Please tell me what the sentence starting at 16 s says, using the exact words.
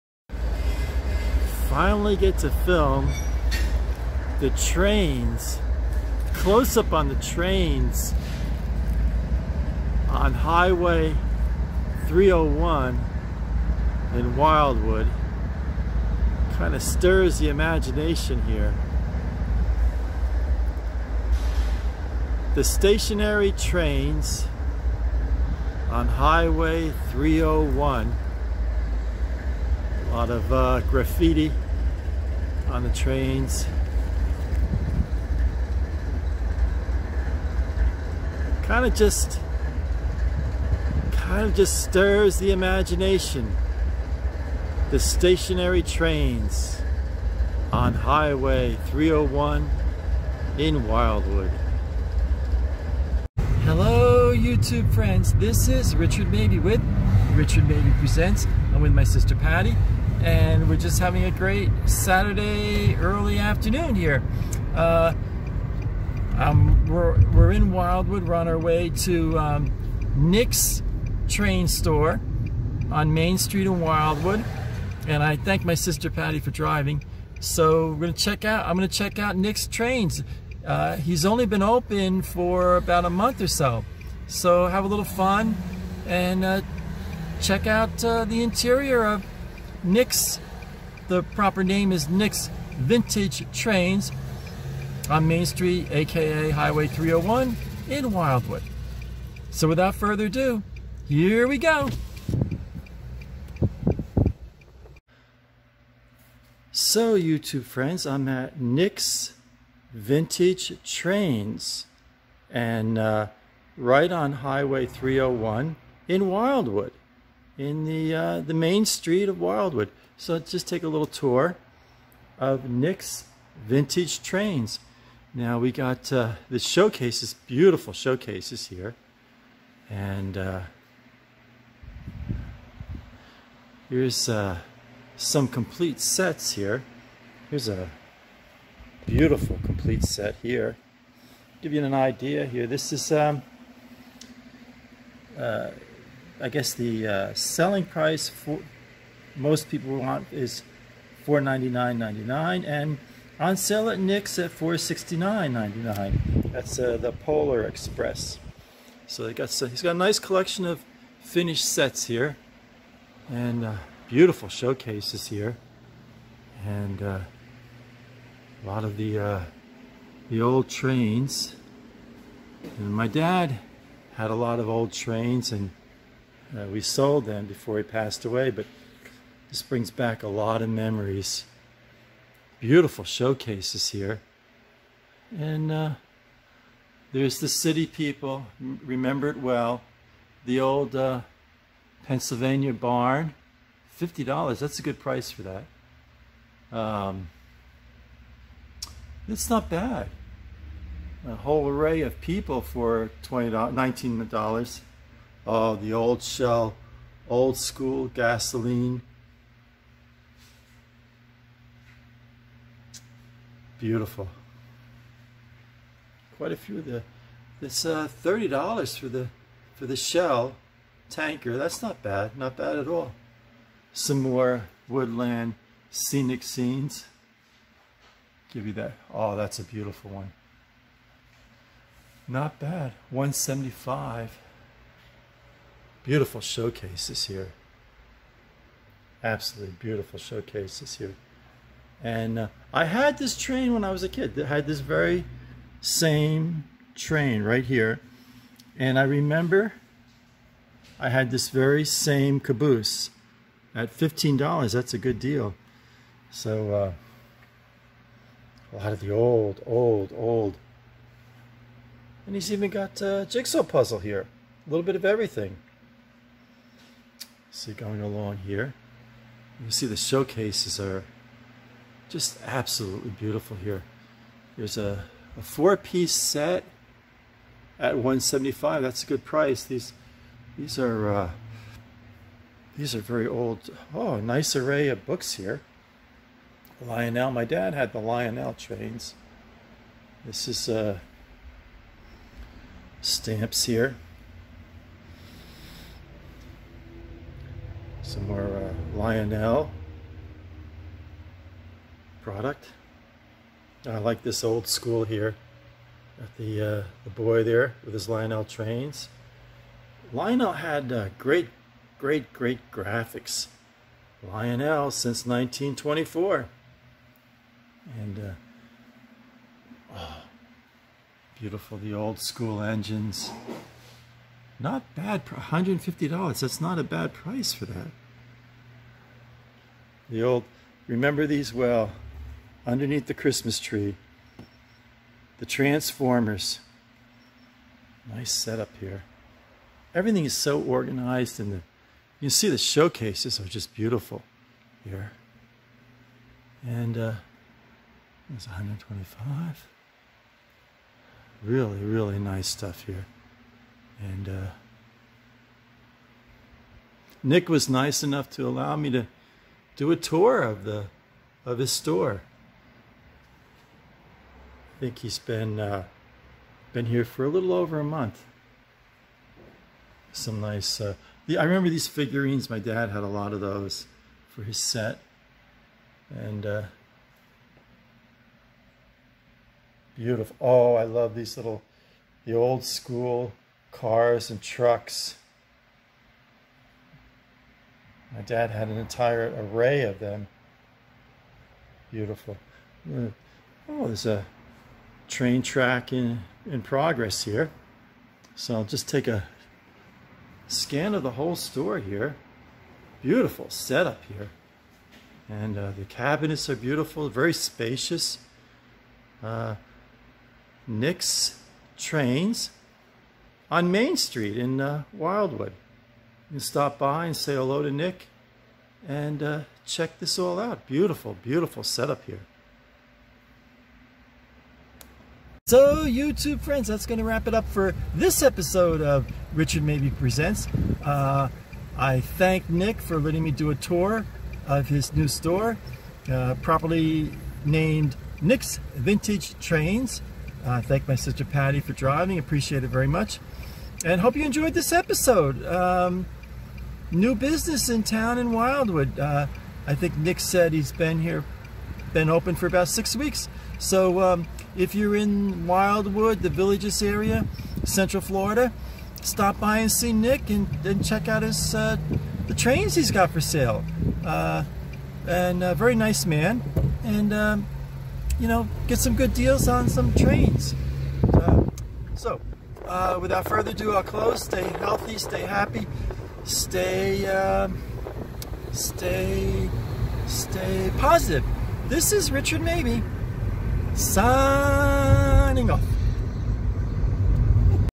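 Kind of stirs the imagination here.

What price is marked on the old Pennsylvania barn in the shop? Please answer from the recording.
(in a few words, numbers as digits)
$50.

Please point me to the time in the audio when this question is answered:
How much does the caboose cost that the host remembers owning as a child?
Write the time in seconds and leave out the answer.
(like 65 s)
253 s.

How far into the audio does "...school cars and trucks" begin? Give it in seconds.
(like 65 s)
382 s.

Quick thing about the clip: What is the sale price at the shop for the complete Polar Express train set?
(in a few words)
$469.99.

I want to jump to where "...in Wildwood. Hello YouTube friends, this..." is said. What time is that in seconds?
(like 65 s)
50 s.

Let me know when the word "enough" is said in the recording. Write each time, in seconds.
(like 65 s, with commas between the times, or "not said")
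358 s.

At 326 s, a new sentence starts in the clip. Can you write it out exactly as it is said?
That's not a bad price for that the old remember these well underneath the Christmas tree.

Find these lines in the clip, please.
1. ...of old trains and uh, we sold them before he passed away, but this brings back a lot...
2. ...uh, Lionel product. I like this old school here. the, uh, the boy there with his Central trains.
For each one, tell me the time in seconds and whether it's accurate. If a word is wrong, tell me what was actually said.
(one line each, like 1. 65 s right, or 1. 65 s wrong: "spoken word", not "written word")
1. 174 s right
2. 298 s wrong: "Lionel", not "Central".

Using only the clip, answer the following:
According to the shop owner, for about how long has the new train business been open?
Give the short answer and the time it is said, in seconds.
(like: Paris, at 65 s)
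Six weeks, at 452 s.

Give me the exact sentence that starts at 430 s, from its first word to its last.
Uh, I thank Nick for letting me do a tour of his new store, uh, properly named Nick's Vintage Trains.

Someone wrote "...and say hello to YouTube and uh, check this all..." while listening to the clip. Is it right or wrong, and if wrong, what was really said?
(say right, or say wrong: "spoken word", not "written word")
wrong: "Nick", not "YouTube".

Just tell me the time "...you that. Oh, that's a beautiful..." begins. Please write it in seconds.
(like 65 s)
228 s.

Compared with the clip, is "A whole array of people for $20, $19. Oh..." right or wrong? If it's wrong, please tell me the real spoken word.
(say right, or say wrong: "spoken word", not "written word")
right.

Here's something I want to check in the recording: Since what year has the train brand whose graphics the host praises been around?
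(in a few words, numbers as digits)
1924.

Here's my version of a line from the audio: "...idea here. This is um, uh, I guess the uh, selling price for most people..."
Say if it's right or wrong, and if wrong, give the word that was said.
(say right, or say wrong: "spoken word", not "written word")
right.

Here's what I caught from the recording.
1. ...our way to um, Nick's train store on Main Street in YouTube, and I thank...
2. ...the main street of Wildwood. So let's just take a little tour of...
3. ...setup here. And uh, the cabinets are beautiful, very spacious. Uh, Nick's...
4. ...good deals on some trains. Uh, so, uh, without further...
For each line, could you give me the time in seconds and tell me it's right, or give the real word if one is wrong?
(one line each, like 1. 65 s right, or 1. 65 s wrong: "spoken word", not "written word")
1. 68 s wrong: "Wildwood", not "YouTube"
2. 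118 s right
3. 403 s right
4. 468 s right.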